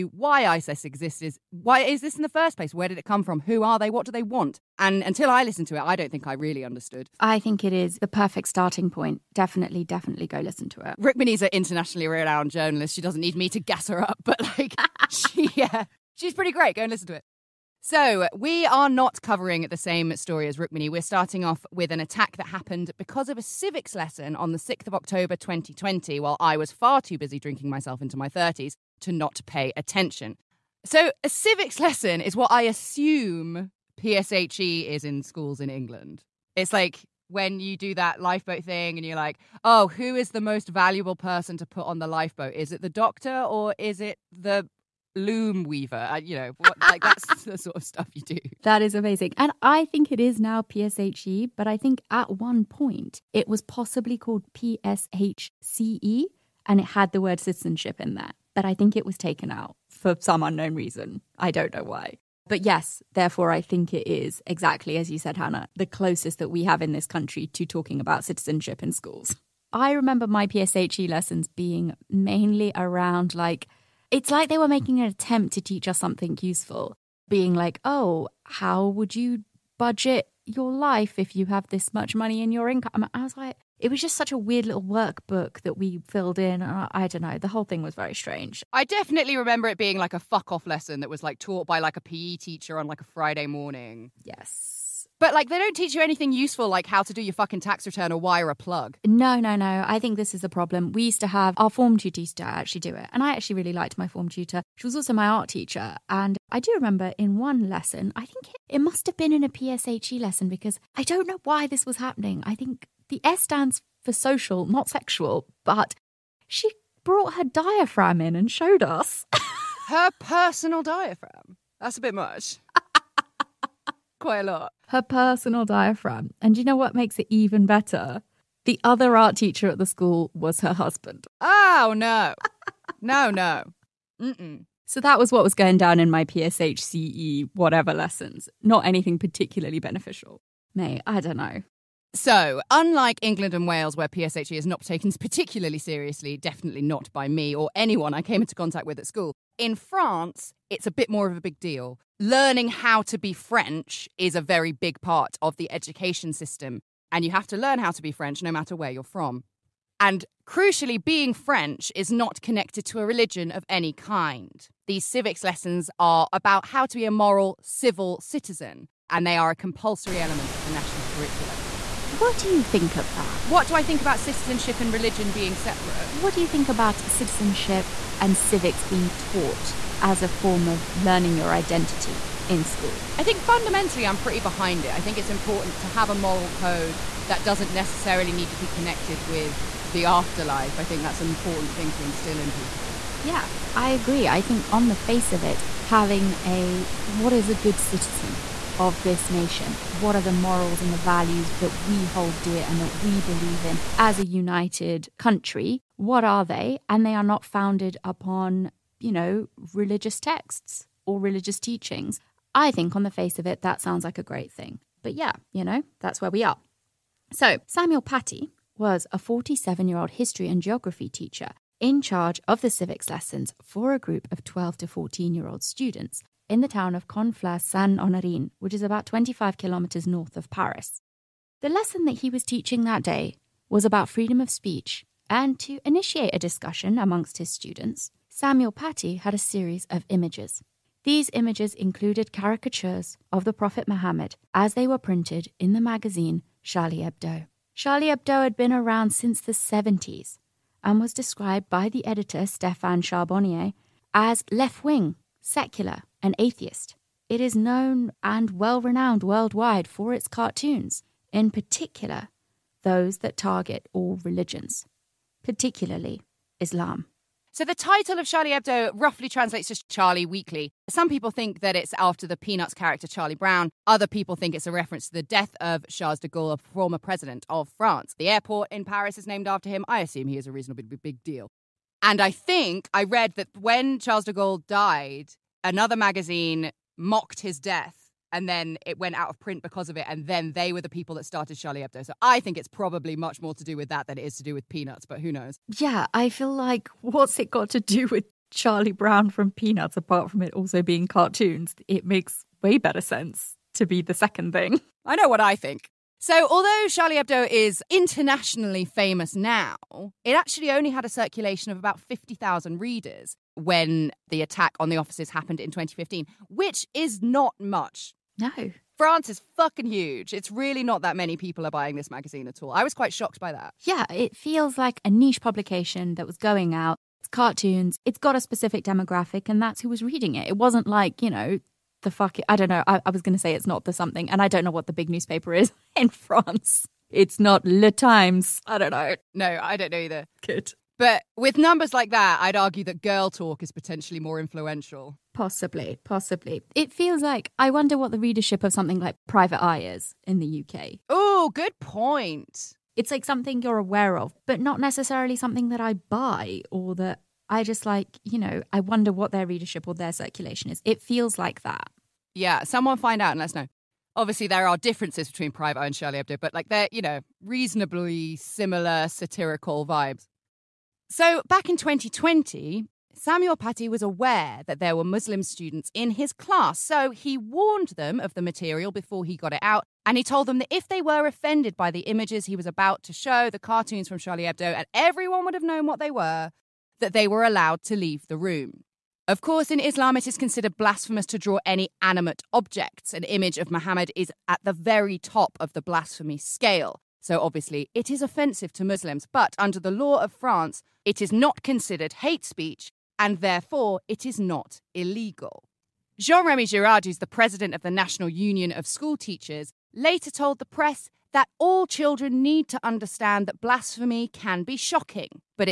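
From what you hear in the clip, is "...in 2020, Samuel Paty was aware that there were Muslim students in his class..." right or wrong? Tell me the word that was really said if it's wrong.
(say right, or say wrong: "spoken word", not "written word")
right.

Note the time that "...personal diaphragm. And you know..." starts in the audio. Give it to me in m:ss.
2:05.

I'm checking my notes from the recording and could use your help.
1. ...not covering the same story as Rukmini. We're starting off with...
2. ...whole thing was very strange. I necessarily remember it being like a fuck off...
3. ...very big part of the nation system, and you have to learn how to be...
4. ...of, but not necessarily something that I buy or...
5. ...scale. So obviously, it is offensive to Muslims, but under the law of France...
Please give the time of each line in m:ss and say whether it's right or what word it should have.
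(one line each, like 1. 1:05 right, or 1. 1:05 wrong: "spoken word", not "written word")
1. 0:18 right
2. 1:27 wrong: "definitely", not "necessarily"
3. 2:34 wrong: "education", not "nation"
4. 5:54 right
5. 6:36 right.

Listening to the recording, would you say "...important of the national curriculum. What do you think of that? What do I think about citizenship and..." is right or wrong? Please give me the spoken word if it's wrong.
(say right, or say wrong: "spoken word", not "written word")
wrong: "element", not "important".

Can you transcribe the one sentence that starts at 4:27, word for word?
So the title of Charlie Hebdo roughly translates to Charlie Weekly.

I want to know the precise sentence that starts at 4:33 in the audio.
Other people think it's a reference to the death of Charles de Gaulle, former president of France.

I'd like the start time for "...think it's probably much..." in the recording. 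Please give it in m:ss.
4:52.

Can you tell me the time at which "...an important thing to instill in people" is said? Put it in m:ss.
3:11.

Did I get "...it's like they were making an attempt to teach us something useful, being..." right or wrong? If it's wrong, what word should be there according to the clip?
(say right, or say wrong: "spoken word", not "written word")
right.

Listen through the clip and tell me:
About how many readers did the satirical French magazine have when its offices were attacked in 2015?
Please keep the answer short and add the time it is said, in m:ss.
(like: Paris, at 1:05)
50,000, at 5:11.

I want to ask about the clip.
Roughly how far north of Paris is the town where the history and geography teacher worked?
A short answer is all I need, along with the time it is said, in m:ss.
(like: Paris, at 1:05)
25 kilometers, at 3:49.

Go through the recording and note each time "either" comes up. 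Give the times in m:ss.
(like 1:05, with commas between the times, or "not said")
5:39.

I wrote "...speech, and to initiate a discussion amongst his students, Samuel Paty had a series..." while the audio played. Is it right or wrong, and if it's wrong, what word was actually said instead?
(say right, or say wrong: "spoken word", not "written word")
right.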